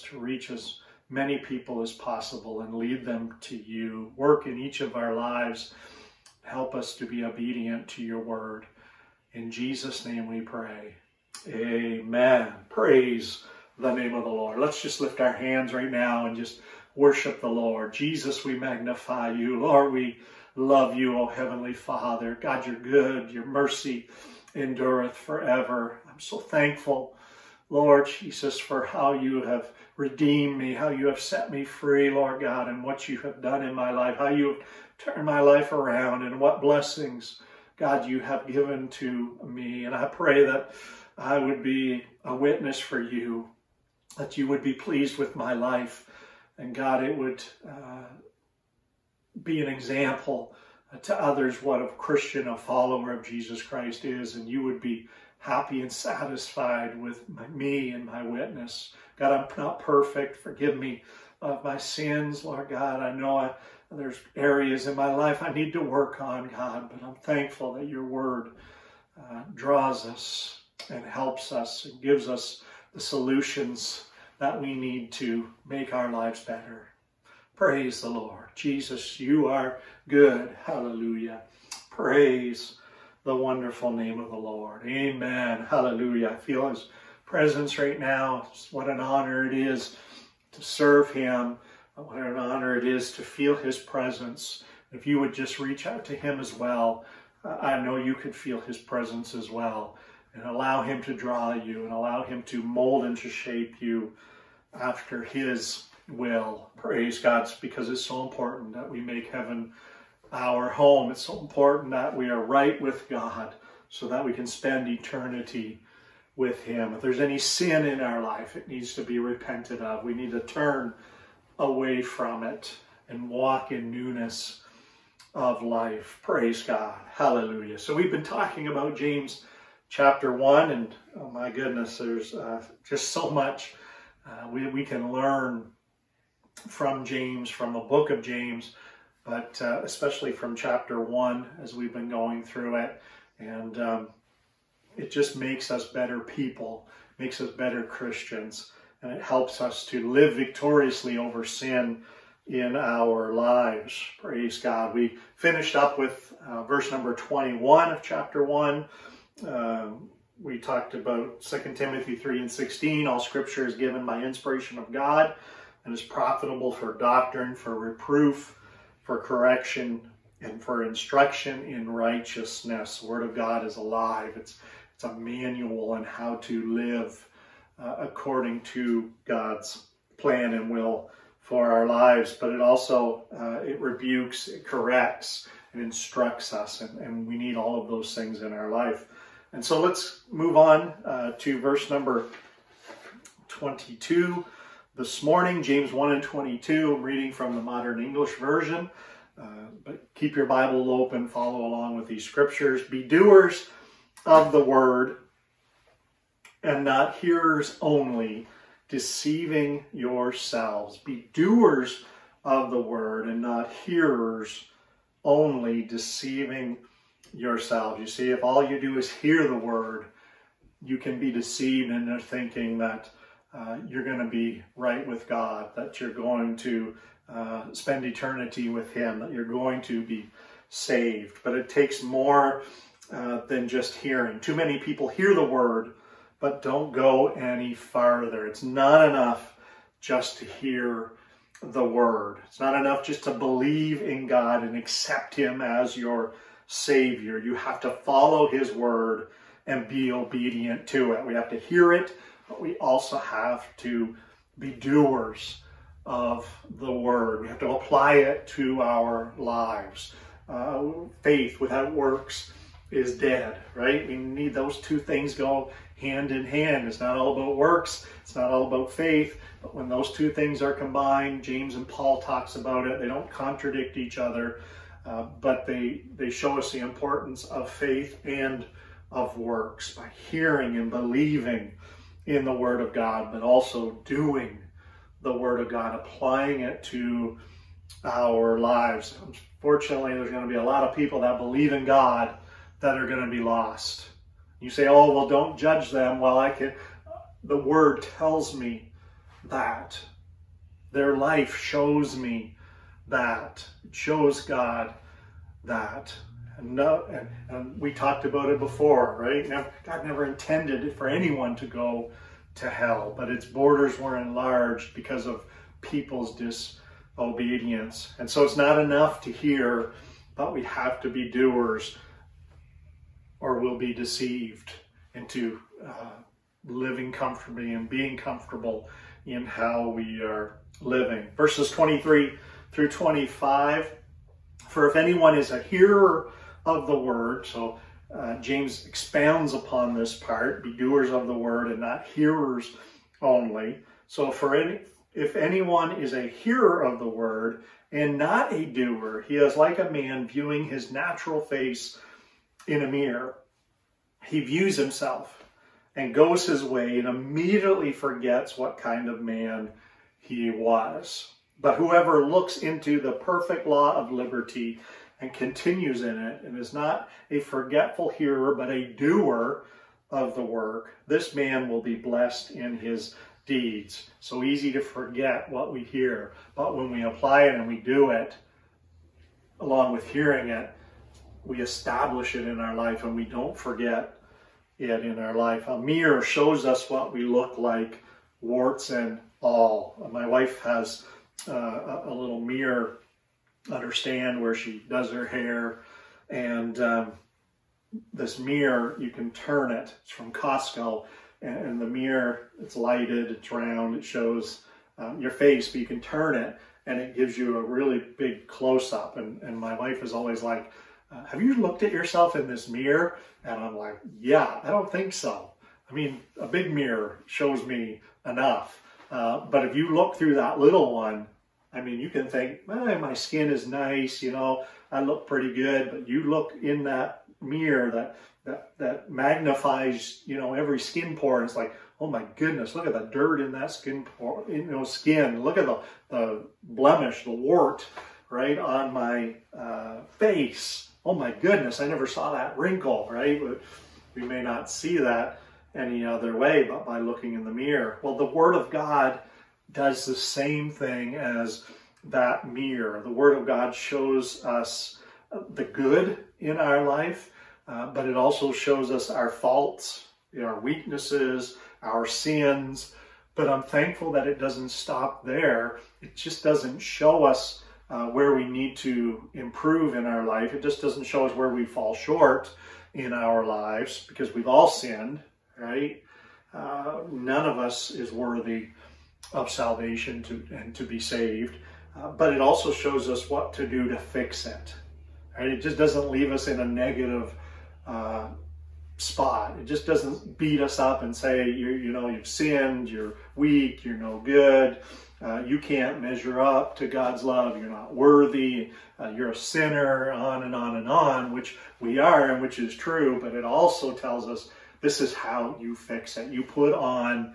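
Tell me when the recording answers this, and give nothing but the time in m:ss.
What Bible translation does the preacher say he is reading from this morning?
3:17.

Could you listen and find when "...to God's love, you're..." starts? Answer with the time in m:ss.
8:16.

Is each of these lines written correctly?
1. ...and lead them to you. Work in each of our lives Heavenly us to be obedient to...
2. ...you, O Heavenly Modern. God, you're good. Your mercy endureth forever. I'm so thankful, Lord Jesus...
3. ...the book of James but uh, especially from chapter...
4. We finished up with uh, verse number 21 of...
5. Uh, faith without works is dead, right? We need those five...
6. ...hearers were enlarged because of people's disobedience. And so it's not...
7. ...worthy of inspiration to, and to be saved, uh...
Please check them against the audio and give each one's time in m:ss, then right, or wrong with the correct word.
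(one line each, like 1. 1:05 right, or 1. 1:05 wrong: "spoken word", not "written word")
1. 0:02 wrong: "Help", not "Heavenly"
2. 0:20 wrong: "Father", not "Modern"
3. 2:17 right
4. 2:34 right
5. 4:20 wrong: "two", not "five"
6. 5:13 wrong: "borders", not "hearers"
7. 7:58 wrong: "salvation", not "inspiration".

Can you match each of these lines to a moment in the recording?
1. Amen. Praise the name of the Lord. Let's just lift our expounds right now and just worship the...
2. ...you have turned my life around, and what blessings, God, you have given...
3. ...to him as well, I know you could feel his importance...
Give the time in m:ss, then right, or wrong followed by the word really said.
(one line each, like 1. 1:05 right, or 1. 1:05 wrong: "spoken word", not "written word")
1. 0:11 wrong: "hands", not "expounds"
2. 0:34 right
3. 1:36 wrong: "presence", not "importance".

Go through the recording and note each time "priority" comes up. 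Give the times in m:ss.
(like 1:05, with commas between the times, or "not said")
not said.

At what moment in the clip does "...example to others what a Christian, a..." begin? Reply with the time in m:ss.
0:49.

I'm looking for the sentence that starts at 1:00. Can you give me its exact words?
Forgive me of my sins, Lord God.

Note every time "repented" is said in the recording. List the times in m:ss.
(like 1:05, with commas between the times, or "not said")
1:59.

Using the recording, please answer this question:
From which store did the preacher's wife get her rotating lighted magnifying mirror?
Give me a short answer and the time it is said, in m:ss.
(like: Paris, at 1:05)
Costco, at 6:40.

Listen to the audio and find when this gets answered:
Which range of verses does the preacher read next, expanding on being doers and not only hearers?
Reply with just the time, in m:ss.
5:31.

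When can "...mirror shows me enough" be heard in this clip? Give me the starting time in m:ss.
6:56.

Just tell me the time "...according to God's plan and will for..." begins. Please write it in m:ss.
2:57.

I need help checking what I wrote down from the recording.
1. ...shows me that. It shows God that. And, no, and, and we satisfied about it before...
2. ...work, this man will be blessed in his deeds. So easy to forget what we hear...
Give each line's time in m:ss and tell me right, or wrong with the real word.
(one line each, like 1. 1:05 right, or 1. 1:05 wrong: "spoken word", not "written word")
1. 5:01 wrong: "talked", not "satisfied"
2. 6:10 right.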